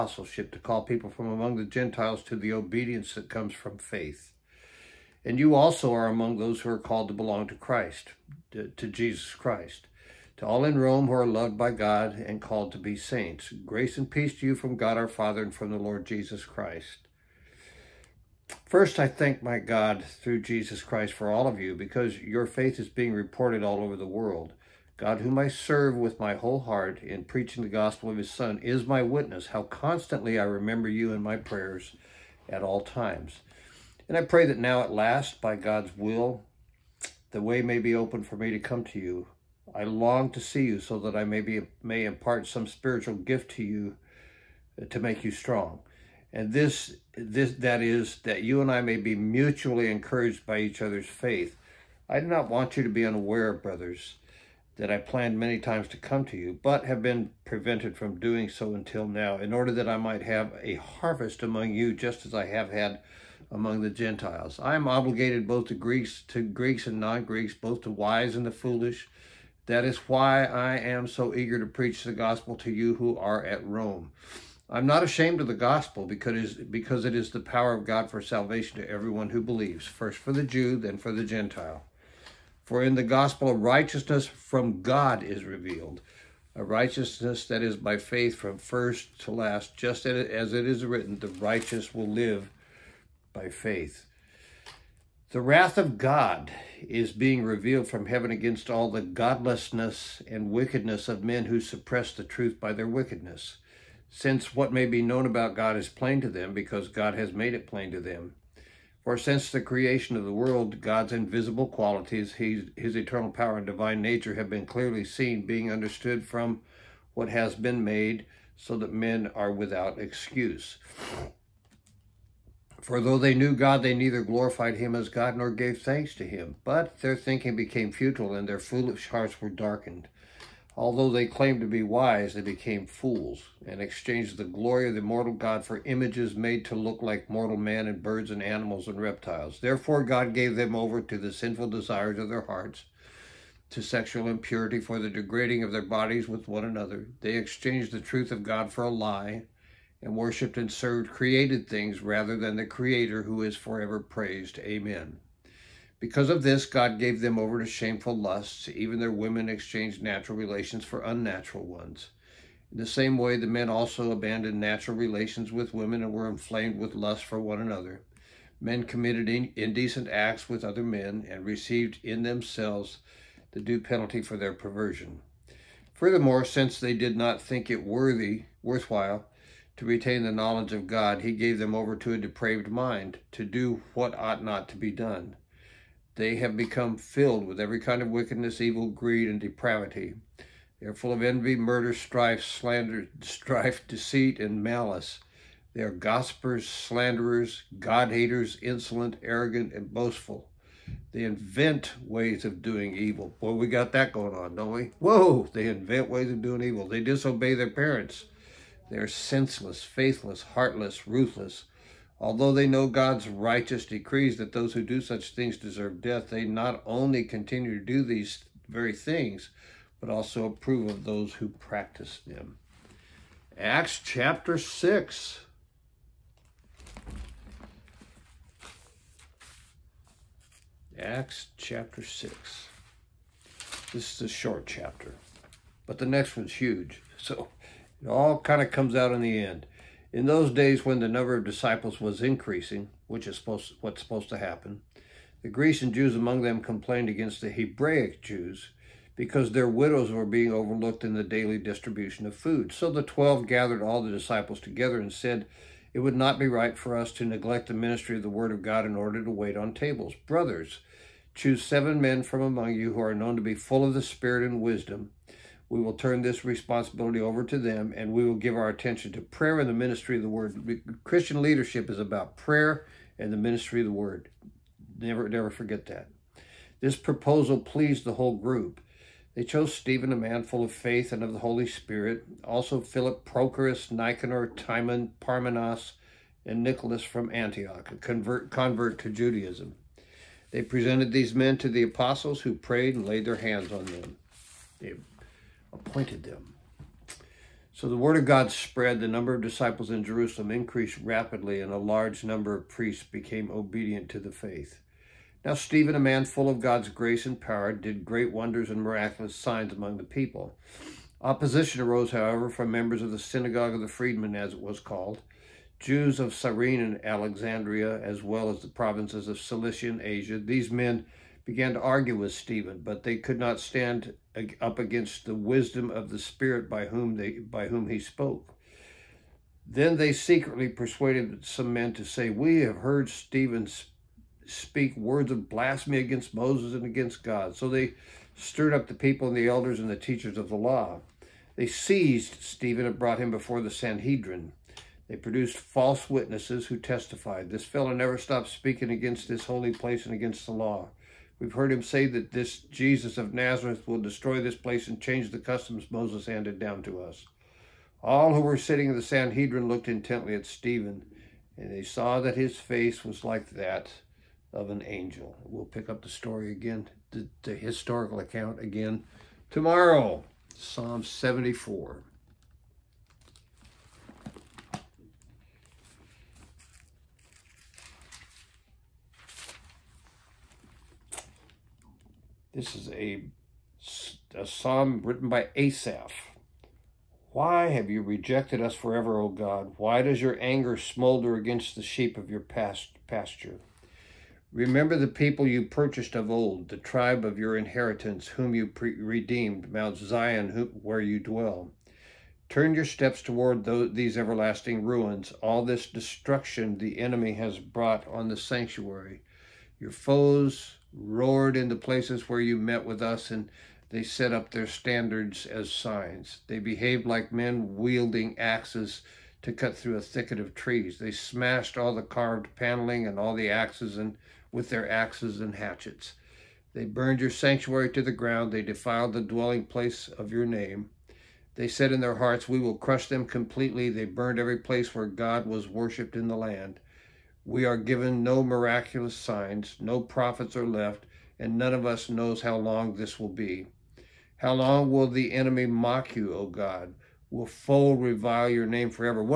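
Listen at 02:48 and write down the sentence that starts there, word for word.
Men committed indecent acts with other men and received in themselves the due penalty for their perversion.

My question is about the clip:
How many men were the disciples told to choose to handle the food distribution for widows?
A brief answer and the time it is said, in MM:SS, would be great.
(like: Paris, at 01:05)
7, at 04:21.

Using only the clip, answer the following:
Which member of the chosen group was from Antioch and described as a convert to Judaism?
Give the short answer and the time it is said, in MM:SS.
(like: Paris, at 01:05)
Nicholas, at 04:46.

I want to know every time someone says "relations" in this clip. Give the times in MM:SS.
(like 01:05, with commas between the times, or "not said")
02:40, 02:44.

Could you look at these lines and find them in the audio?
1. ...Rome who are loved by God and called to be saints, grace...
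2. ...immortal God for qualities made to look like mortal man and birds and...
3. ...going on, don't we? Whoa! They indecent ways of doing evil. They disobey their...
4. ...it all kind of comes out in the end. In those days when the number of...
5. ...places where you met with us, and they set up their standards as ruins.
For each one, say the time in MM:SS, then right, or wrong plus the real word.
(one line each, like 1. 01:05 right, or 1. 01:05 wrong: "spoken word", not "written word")
1. 00:10 right
2. 02:14 wrong: "images", not "qualities"
3. 03:24 wrong: "invent", not "indecent"
4. 03:58 right
5. 06:51 wrong: "signs", not "ruins".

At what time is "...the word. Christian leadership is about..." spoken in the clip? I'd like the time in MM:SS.
04:30.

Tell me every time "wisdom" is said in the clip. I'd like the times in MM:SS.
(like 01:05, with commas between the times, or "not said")
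04:24, 05:25.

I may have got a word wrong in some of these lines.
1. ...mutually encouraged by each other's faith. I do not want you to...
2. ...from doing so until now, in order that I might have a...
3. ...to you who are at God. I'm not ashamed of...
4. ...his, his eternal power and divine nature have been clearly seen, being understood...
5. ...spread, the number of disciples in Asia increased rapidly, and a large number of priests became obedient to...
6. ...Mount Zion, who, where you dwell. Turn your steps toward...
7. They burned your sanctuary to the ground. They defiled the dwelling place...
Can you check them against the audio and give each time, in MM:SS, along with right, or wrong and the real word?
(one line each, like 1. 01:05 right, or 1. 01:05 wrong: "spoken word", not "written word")
1. 00:49 right
2. 00:57 right
3. 01:12 wrong: "Rome", not "God"
4. 01:52 right
5. 04:58 wrong: "Jerusalem", not "Asia"
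6. 06:39 right
7. 07:06 right.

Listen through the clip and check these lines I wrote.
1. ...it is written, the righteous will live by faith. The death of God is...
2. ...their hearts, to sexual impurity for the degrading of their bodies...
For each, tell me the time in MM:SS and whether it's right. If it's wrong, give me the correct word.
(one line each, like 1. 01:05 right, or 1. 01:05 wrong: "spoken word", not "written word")
1. 01:30 wrong: "wrath", not "death"
2. 02:22 right.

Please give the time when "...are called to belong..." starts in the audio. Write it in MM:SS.
00:06.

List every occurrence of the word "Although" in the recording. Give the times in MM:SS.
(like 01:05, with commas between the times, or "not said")
02:10, 03:32.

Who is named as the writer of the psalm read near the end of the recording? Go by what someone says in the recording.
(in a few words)
Asaph.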